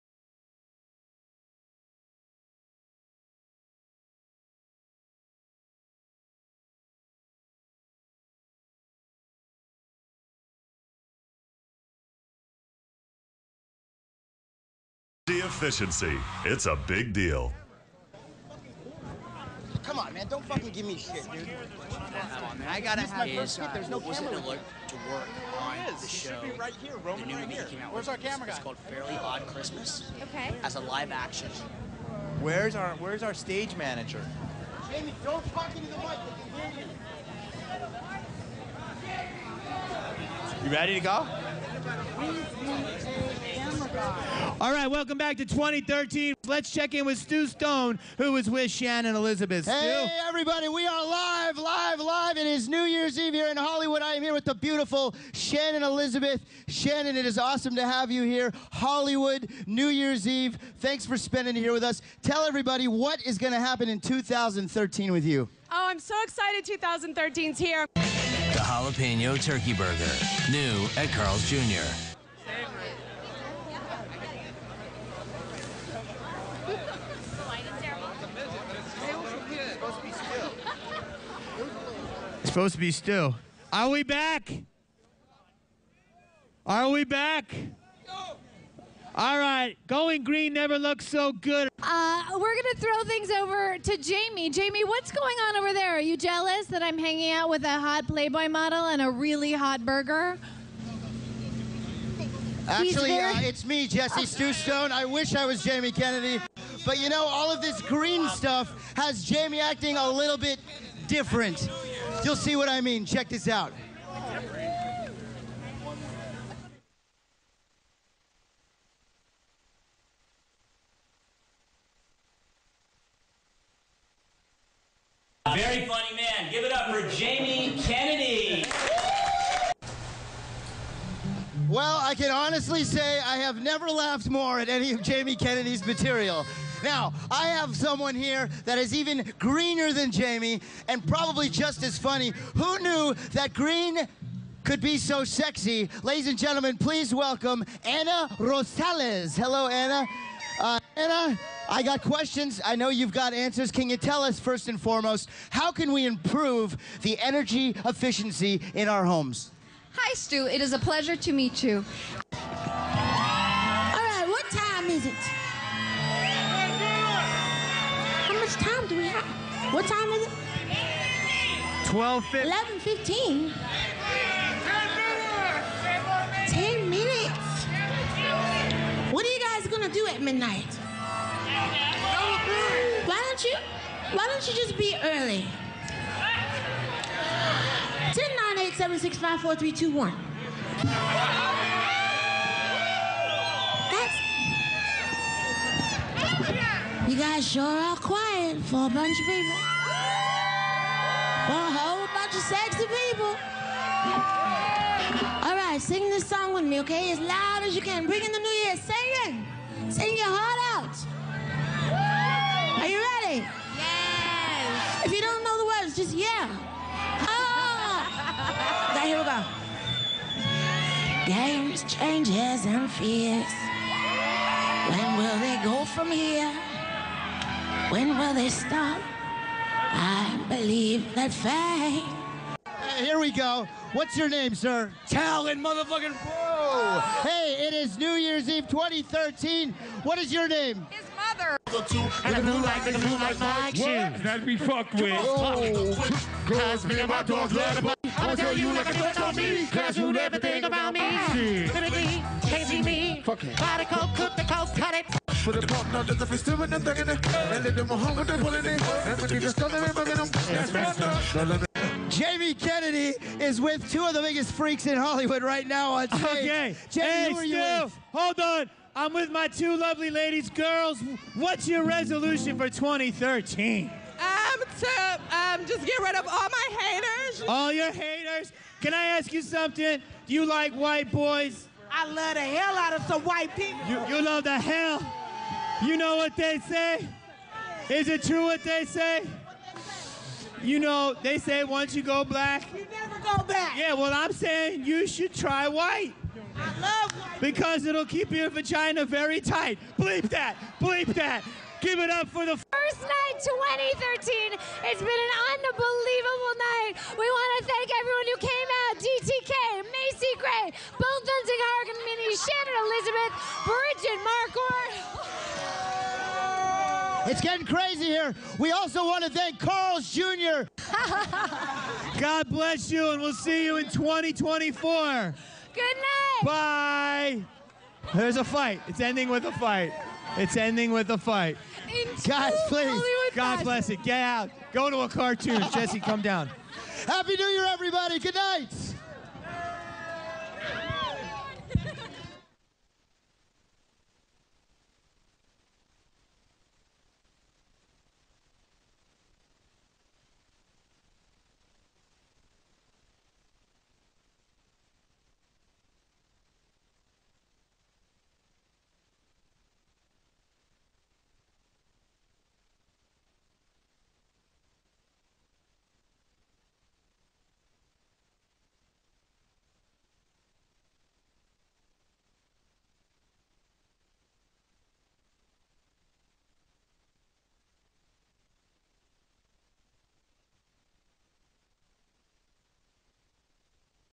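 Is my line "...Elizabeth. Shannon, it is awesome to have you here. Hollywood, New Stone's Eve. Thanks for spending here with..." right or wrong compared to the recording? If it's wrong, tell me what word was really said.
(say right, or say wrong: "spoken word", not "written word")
wrong: "Year", not "Stone".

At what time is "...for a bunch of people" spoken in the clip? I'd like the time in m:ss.
3:18.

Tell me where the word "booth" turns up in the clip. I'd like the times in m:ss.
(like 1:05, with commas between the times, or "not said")
not said.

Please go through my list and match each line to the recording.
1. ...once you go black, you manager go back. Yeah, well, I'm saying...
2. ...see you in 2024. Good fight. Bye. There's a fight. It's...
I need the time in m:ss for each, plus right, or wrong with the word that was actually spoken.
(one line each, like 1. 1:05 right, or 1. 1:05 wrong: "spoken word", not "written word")
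1. 4:51 wrong: "never", not "manager"
2. 5:23 wrong: "night", not "fight".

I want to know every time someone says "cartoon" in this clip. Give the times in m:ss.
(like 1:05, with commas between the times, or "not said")
5:35.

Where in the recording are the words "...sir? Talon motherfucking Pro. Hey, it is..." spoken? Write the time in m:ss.
3:54.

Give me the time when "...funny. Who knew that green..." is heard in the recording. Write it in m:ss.
2:21.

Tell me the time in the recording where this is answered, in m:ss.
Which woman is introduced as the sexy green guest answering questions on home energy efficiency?
2:27.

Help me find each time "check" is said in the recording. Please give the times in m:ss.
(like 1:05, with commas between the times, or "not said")
0:46, 1:53.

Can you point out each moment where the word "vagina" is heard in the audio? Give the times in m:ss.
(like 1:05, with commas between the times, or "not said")
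4:58.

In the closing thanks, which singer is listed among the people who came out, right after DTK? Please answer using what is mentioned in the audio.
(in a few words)
Macy Gray.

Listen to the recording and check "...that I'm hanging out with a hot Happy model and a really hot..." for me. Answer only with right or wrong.
wrong.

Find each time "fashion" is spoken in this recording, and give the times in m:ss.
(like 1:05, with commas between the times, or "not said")
5:33.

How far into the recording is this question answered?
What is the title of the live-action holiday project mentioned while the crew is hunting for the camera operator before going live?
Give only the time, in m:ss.
0:28.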